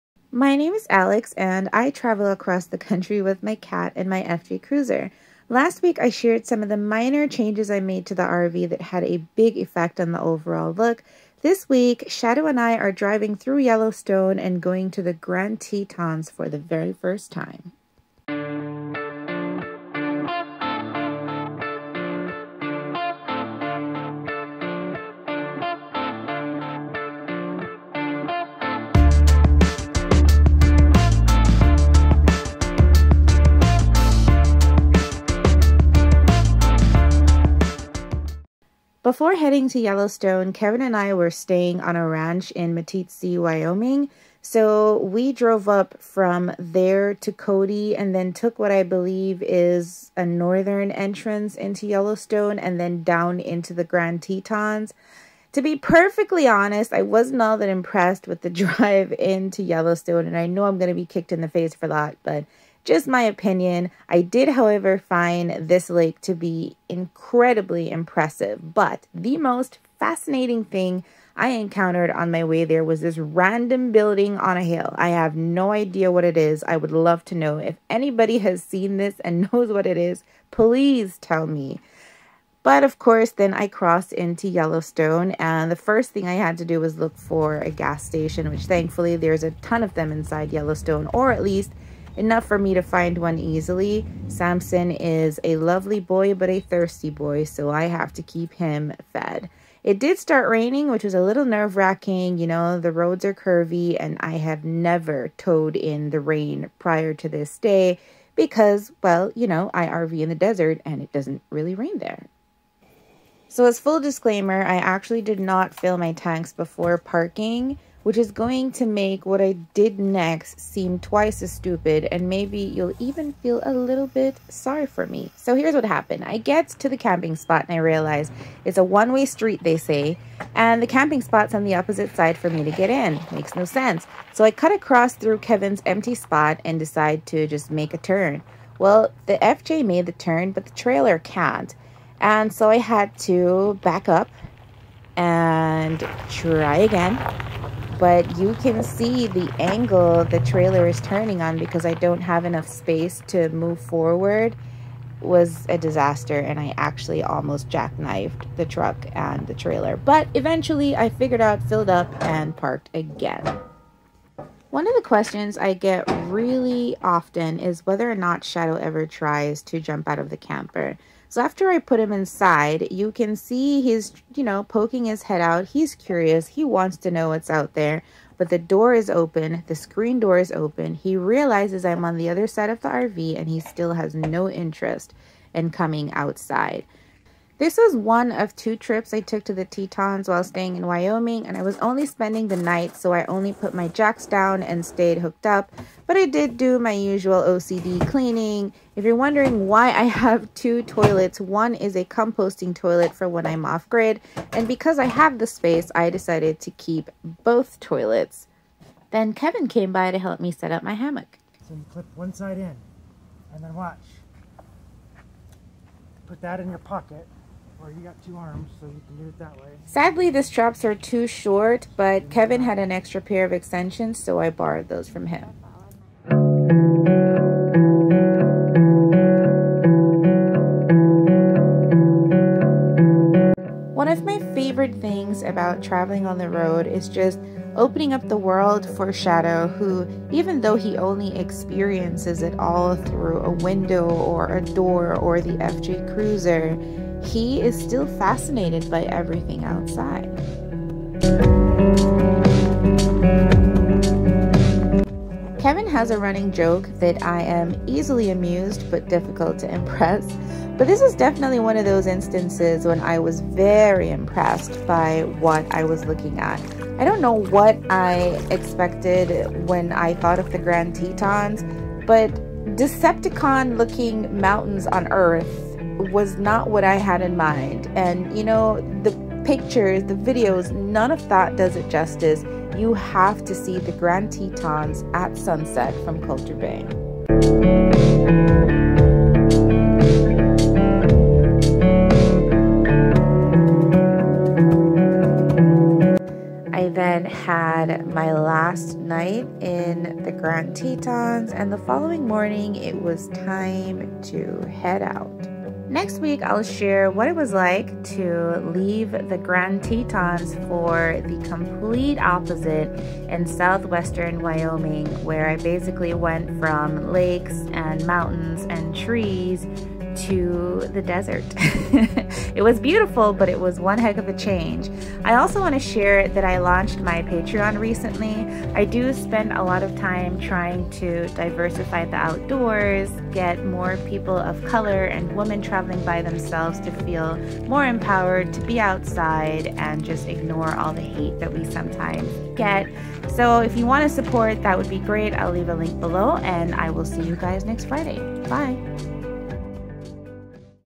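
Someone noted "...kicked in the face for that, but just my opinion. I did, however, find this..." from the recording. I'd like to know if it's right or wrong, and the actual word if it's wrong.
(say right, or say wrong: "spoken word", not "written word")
right.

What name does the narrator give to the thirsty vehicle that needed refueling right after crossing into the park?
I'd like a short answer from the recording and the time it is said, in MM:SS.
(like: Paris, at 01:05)
Samson, at 01:34.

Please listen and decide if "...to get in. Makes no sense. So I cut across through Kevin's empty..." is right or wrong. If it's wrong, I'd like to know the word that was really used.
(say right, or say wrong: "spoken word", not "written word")
right.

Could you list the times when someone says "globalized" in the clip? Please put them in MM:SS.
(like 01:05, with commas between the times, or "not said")
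not said.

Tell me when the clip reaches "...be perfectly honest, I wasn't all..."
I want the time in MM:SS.
00:55.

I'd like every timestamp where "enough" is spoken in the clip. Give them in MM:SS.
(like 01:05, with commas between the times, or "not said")
01:32, 02:32.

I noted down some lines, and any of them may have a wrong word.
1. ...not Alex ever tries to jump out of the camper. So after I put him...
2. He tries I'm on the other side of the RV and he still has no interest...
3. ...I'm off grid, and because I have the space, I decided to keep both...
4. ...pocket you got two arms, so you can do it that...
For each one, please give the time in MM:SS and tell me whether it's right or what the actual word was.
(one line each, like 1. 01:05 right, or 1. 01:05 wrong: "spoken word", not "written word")
1. 02:48 wrong: "Shadow", not "Alex"
2. 03:00 wrong: "realizes", not "tries"
3. 03:23 right
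4. 03:36 right.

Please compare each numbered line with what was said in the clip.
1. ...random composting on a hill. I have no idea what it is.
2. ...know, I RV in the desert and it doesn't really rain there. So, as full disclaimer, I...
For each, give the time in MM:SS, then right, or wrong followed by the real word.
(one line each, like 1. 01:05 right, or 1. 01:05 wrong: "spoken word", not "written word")
1. 01:13 wrong: "building", not "composting"
2. 01:49 right.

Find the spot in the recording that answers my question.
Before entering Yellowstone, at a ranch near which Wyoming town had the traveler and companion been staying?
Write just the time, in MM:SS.
00:42.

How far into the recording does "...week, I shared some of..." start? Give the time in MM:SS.
00:05.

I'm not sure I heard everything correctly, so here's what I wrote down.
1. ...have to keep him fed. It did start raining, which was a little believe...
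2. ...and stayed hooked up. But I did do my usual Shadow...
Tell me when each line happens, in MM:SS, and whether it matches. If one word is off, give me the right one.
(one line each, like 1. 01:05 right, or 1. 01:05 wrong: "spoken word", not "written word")
1. 01:37 wrong: "nerve", not "believe"
2. 03:14 wrong: "OCD", not "Shadow".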